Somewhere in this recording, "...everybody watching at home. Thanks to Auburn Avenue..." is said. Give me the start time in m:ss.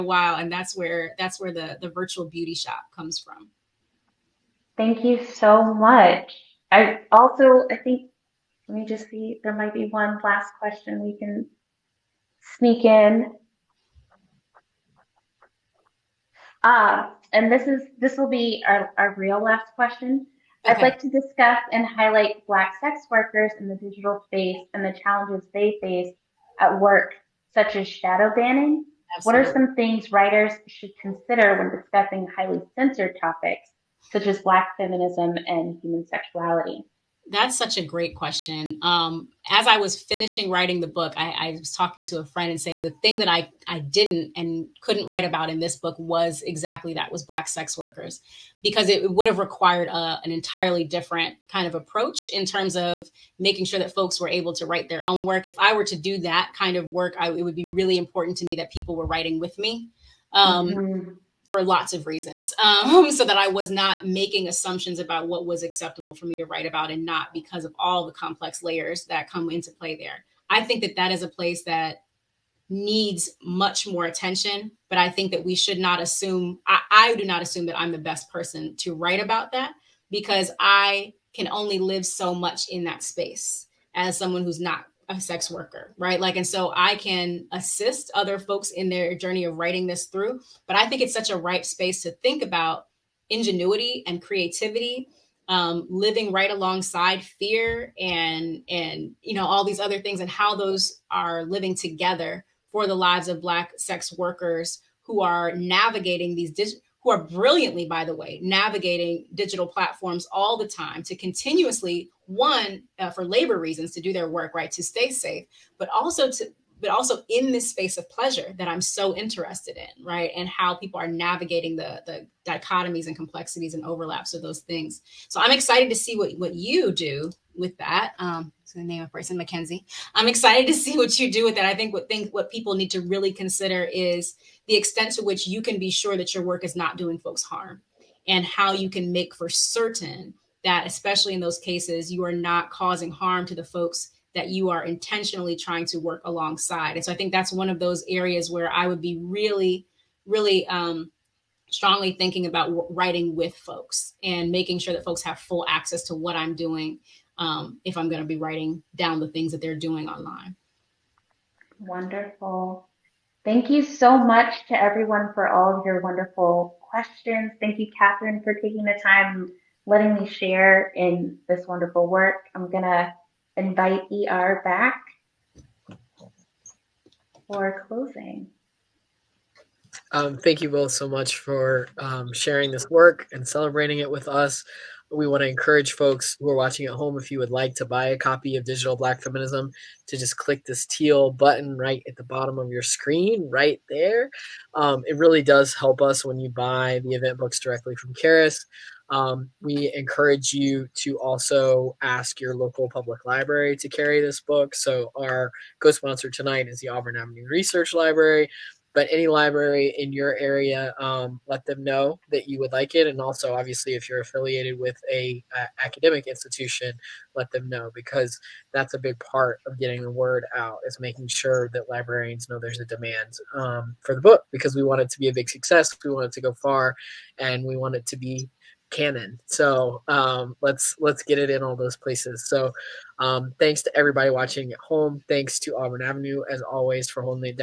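3:53.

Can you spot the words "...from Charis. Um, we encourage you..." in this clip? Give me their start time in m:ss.
3:17.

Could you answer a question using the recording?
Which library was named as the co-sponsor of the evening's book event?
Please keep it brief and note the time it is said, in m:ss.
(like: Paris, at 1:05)
Auburn Avenue Research Library, at 3:26.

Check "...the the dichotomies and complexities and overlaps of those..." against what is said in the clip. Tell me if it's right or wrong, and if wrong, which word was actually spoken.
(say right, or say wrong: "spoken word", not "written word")
right.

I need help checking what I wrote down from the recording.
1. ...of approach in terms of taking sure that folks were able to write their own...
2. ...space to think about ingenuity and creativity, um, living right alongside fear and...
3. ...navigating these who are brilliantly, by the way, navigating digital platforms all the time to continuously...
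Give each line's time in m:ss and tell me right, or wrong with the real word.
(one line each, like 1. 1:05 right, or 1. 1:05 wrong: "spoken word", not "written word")
1. 0:51 wrong: "making", not "taking"
2. 1:31 right
3. 1:45 right.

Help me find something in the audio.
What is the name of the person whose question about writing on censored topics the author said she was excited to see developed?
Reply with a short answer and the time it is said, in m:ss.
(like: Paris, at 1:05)
Mackenzie, at 2:09.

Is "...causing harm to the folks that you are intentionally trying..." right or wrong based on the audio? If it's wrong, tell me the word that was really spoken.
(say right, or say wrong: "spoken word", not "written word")
right.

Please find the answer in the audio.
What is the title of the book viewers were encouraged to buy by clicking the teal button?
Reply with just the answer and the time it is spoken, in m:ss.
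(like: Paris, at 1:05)
Digital Black Feminism, at 3:08.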